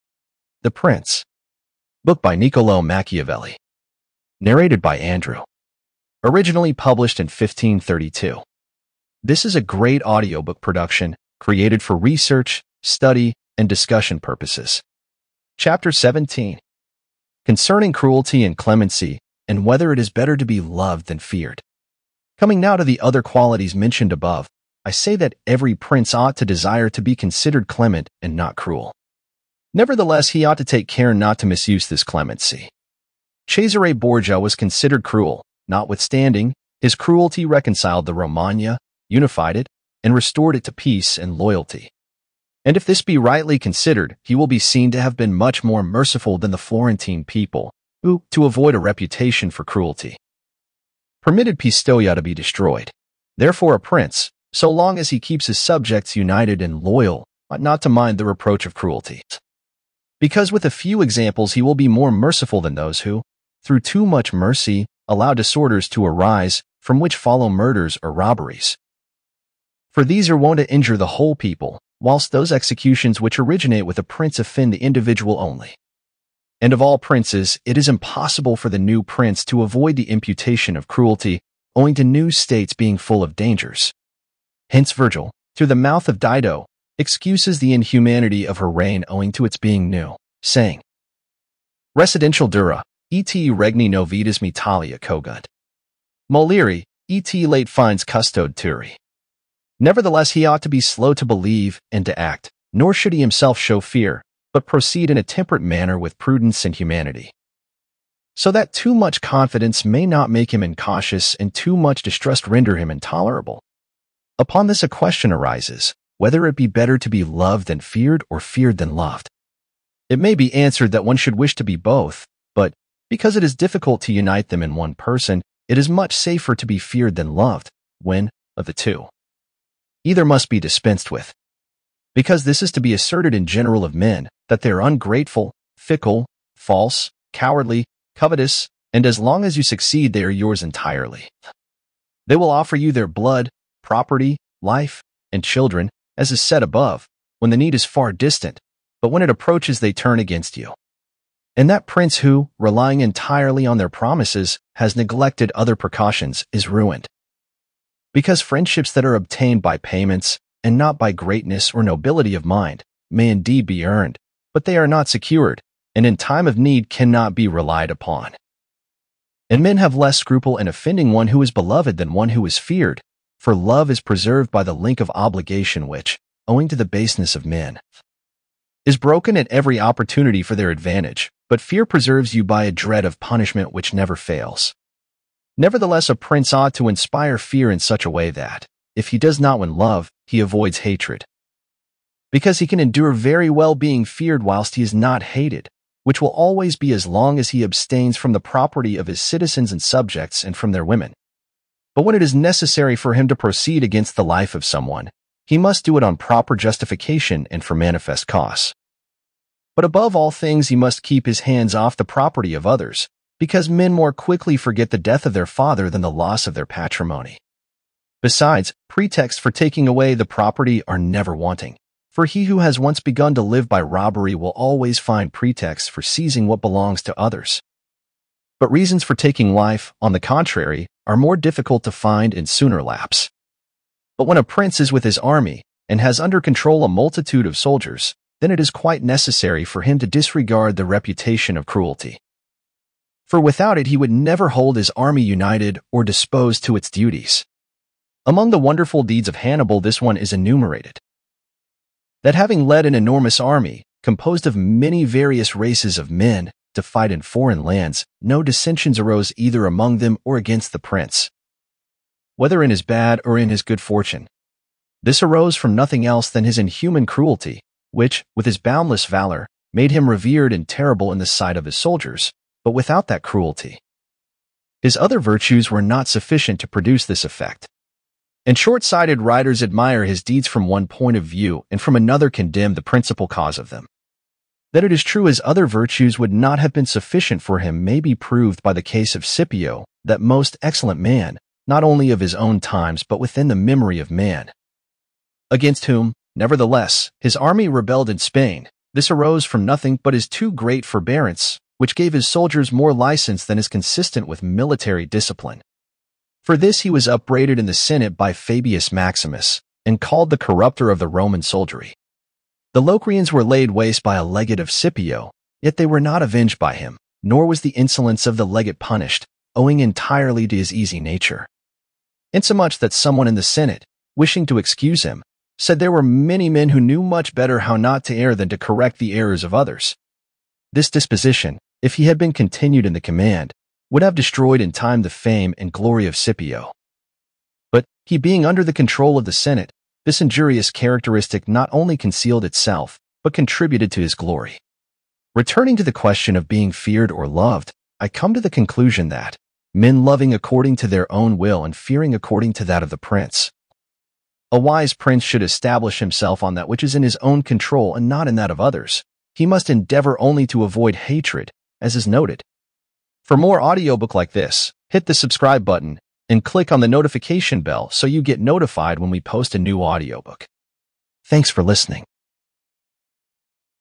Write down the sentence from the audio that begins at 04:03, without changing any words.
For without it he would never hold his army united or disposed to its duties.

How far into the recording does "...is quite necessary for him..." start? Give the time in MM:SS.
03:58.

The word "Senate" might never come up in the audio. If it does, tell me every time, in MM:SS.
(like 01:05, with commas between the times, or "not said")
05:07, 05:23, 05:39.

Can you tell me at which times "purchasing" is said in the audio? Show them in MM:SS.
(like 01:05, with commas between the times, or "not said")
not said.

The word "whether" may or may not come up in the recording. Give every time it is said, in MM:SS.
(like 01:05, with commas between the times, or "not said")
00:19, 01:56, 04:22.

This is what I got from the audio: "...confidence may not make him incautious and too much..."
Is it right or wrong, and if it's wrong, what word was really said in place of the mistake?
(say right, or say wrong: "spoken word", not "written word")
right.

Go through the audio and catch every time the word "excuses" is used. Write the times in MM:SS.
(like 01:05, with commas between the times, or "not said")
01:26, 05:24.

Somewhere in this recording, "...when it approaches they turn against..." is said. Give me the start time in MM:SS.
02:29.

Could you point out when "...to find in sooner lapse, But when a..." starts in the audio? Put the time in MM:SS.
03:51.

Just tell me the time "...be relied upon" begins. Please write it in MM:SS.
02:47.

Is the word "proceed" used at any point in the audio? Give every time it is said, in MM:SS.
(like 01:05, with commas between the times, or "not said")
01:44, 03:23.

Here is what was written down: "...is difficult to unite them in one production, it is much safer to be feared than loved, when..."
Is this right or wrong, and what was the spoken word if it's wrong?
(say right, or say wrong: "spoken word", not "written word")
wrong: "person", not "production".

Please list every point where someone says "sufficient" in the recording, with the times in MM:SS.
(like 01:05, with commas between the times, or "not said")
04:36, 04:46.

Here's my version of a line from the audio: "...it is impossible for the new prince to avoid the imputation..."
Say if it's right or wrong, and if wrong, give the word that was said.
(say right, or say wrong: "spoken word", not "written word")
right.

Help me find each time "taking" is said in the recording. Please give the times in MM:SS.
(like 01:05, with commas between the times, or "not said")
03:39, 03:49.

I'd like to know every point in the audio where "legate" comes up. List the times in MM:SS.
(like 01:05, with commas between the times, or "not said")
05:14, 05:18.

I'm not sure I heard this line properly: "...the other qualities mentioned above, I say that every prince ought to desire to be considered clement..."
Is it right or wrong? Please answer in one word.
right.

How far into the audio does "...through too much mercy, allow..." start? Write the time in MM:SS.
01:03.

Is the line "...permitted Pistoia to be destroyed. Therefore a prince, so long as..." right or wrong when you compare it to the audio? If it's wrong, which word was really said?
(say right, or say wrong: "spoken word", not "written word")
right.